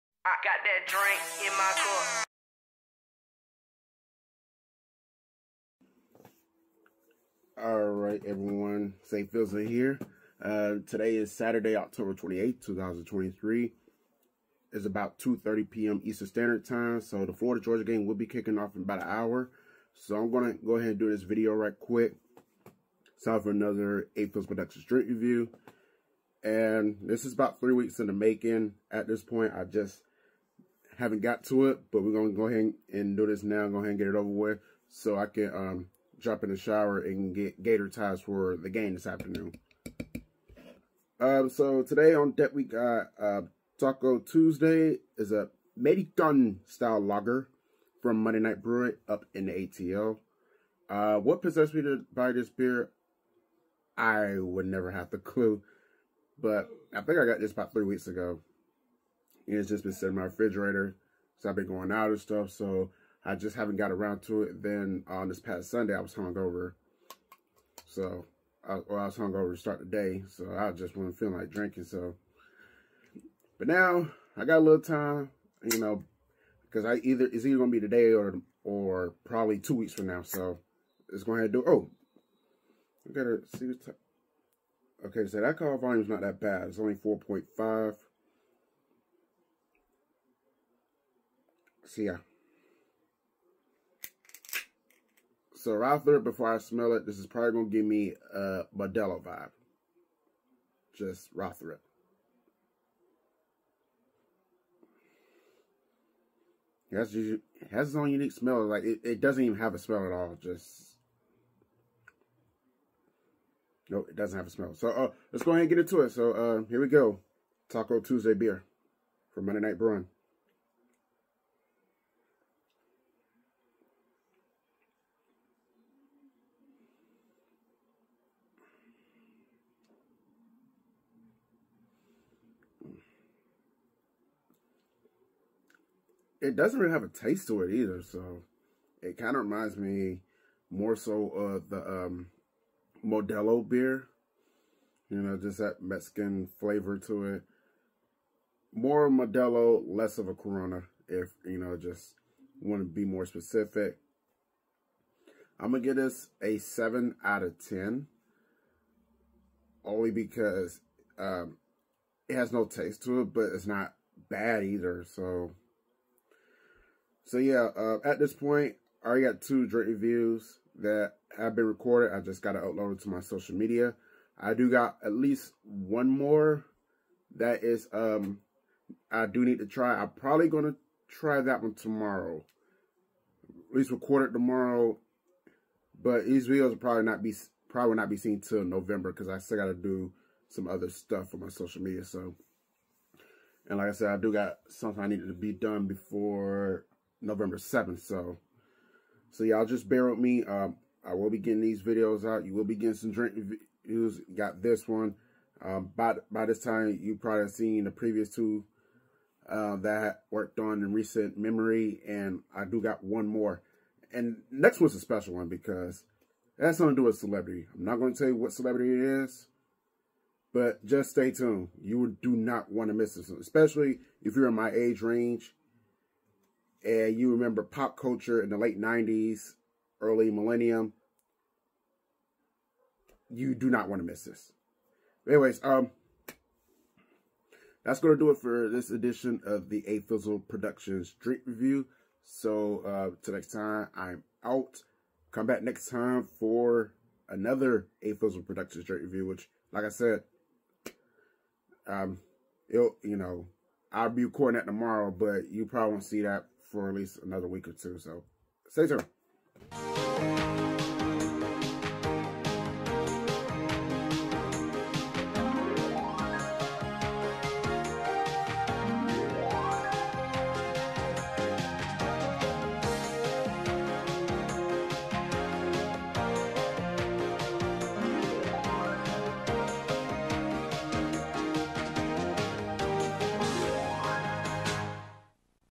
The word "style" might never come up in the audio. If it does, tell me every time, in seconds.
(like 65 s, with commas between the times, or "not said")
46 s.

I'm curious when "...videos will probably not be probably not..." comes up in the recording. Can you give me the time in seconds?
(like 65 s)
186 s.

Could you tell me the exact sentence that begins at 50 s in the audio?
Uh, what possessed me to buy this beer?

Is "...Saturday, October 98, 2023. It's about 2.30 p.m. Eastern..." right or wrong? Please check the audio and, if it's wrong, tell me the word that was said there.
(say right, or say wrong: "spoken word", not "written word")
wrong: "28", not "98".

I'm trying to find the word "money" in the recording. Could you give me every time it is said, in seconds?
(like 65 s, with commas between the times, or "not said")
not said.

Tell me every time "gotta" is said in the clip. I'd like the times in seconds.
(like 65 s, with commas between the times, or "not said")
83 s, 189 s.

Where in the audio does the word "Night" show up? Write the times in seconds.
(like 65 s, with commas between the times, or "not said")
48 s, 119 s.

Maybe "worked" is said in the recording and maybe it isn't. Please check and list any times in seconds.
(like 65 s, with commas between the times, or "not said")
210 s.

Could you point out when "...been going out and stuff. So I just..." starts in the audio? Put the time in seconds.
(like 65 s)
61 s.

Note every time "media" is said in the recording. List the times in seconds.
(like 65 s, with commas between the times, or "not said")
173 s, 191 s.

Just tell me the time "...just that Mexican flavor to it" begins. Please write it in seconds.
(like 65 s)
145 s.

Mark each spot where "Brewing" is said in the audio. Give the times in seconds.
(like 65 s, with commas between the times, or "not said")
48 s, 119 s.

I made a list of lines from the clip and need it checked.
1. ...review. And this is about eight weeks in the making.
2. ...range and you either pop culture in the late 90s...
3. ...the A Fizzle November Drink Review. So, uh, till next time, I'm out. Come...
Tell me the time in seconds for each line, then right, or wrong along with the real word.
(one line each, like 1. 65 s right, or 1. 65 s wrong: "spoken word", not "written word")
1. 25 s wrong: "three", not "eight"
2. 225 s wrong: "remember", not "either"
3. 239 s wrong: "Productions", not "November".